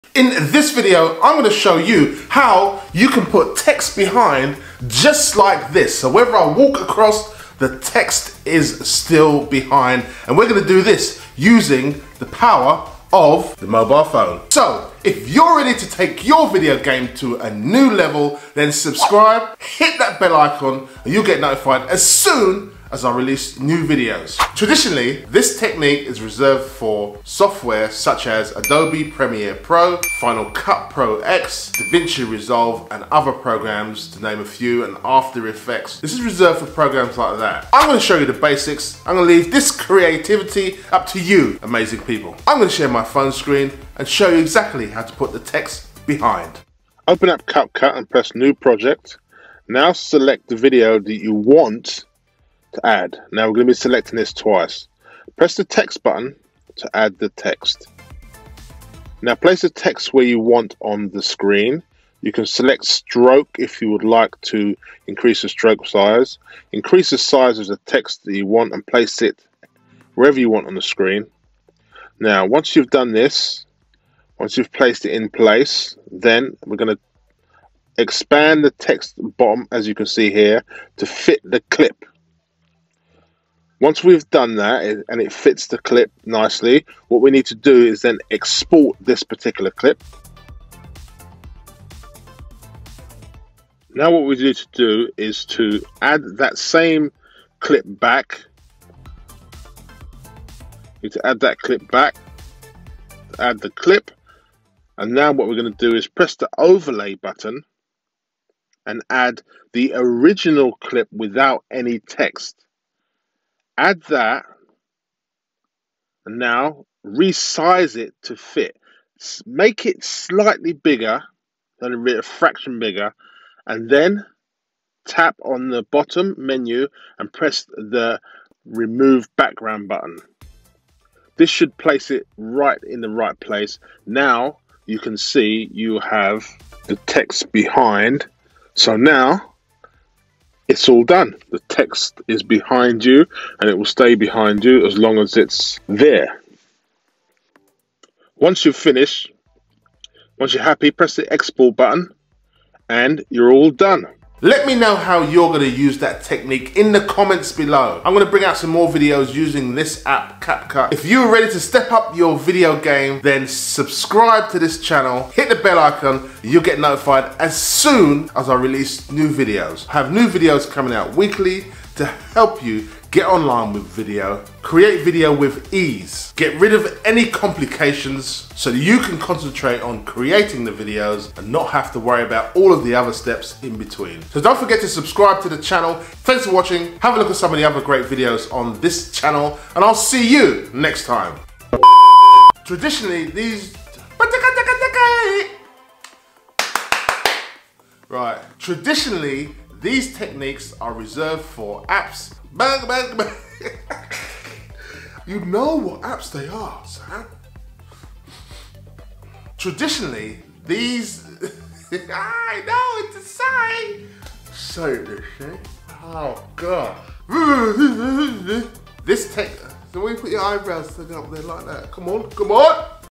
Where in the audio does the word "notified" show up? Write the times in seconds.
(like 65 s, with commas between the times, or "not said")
21 s, 166 s.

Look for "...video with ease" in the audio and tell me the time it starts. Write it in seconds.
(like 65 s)
175 s.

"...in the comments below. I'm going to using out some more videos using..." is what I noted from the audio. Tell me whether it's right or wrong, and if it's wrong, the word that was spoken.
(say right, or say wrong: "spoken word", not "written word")
wrong: "bring", not "using".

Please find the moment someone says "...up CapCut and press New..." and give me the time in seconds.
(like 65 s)
47 s.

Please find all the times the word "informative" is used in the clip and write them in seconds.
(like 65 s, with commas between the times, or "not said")
not said.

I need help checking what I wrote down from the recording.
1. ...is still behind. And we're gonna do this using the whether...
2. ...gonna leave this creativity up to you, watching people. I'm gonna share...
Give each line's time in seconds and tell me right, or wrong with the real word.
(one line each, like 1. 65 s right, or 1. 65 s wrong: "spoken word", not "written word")
1. 8 s wrong: "power", not "whether"
2. 39 s wrong: "amazing", not "watching".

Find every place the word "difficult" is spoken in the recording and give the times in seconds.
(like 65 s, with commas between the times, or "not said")
not said.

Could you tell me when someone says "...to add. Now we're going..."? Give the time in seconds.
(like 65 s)
52 s.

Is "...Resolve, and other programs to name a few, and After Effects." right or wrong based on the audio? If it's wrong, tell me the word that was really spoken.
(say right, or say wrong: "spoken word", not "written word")
right.